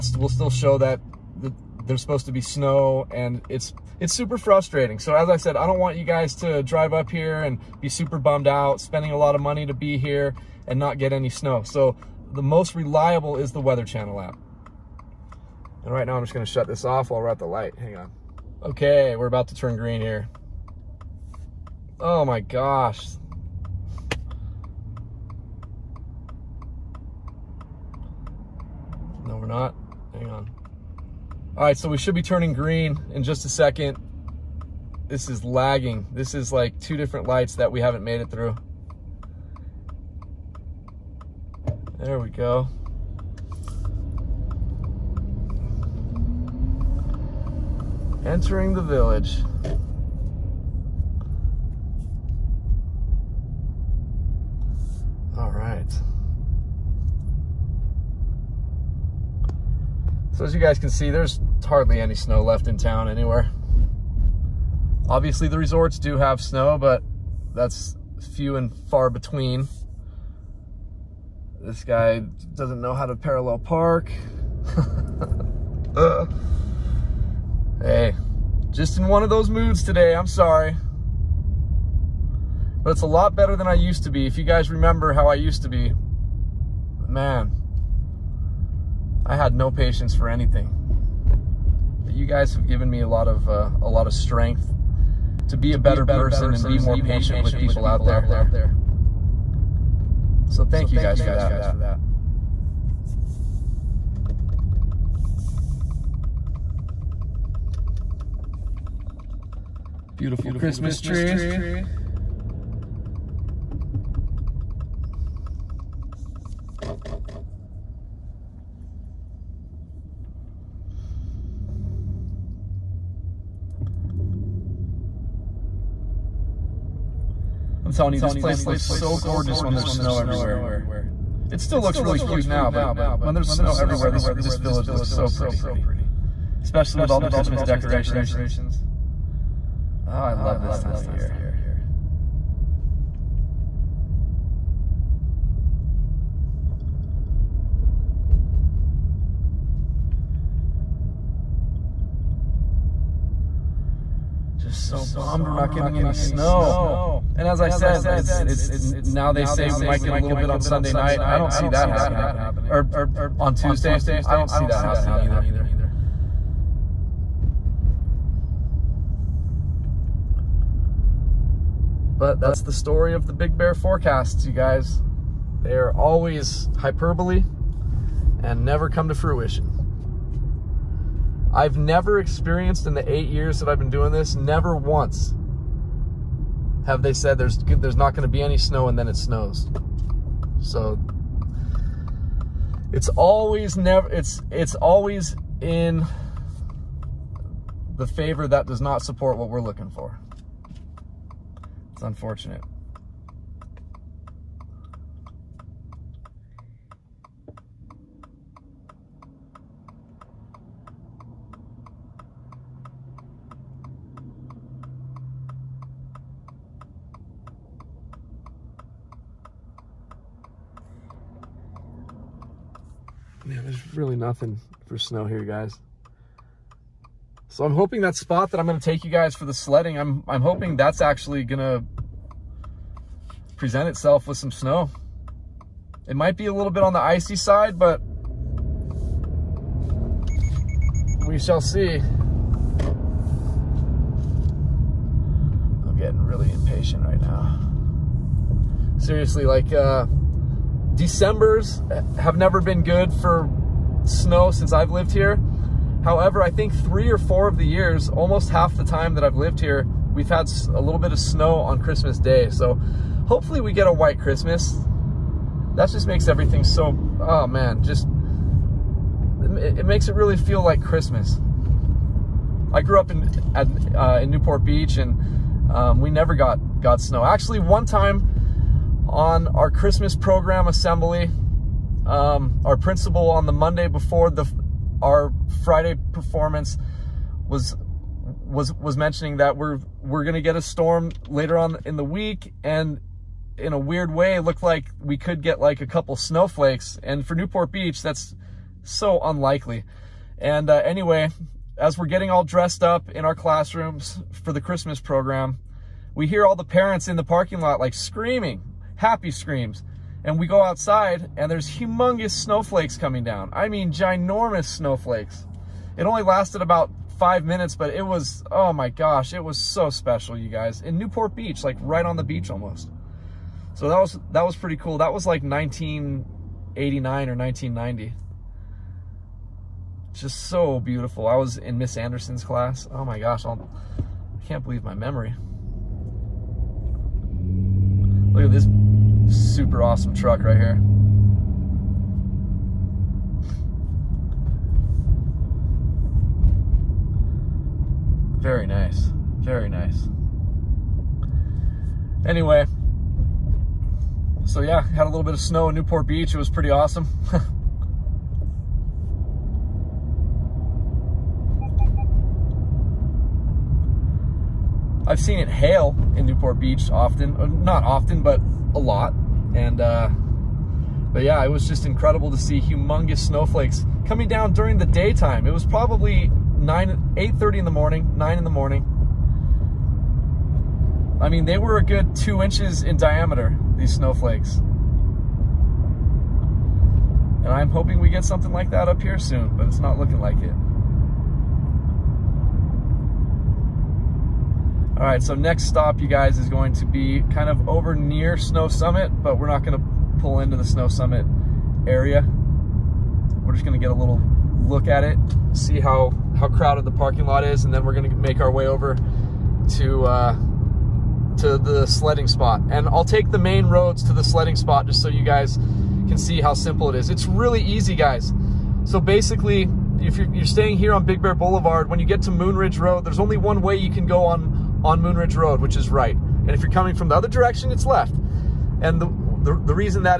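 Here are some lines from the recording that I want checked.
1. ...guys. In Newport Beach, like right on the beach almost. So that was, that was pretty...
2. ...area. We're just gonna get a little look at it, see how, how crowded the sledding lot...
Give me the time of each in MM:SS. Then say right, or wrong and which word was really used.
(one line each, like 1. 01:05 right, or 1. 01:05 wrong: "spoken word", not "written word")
1. 05:20 right
2. 06:41 wrong: "parking", not "sledding".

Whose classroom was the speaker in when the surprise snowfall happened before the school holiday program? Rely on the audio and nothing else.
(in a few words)
Miss Anderson.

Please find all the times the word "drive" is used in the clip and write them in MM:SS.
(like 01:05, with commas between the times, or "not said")
00:06.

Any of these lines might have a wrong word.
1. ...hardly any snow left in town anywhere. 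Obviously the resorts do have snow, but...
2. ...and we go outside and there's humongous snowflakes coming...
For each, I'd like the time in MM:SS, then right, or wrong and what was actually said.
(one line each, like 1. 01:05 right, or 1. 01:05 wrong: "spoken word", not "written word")
1. 01:01 right
2. 05:10 right.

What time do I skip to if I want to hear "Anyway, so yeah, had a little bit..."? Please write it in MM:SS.
05:52.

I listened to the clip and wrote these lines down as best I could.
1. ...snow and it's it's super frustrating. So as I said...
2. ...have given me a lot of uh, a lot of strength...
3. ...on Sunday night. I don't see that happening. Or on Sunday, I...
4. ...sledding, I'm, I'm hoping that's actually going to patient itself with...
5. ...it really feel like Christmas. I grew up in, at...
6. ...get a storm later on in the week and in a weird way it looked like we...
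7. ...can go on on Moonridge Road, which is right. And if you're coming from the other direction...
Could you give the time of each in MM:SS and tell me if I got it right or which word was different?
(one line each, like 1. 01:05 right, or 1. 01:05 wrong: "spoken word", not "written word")
1. 00:02 right
2. 01:32 right
3. 02:40 wrong: "Tuesday", not "Sunday"
4. 03:49 wrong: "present", not "patient"
5. 04:30 right
6. 04:50 right
7. 07:03 right.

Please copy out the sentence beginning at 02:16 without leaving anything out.
Especially with all the Christmas decorations.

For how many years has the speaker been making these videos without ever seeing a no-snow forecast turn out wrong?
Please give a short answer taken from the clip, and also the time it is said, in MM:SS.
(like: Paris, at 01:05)
8, at 03:03.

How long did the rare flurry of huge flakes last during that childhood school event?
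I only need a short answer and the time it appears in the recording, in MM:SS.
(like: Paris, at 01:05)
5 minutes, at 05:16.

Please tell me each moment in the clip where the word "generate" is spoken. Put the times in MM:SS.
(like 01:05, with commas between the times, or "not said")
not said.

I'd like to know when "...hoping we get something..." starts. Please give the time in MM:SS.
06:27.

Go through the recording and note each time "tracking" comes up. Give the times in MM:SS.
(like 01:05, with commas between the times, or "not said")
not said.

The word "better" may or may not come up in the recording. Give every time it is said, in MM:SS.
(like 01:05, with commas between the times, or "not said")
01:23, 01:35.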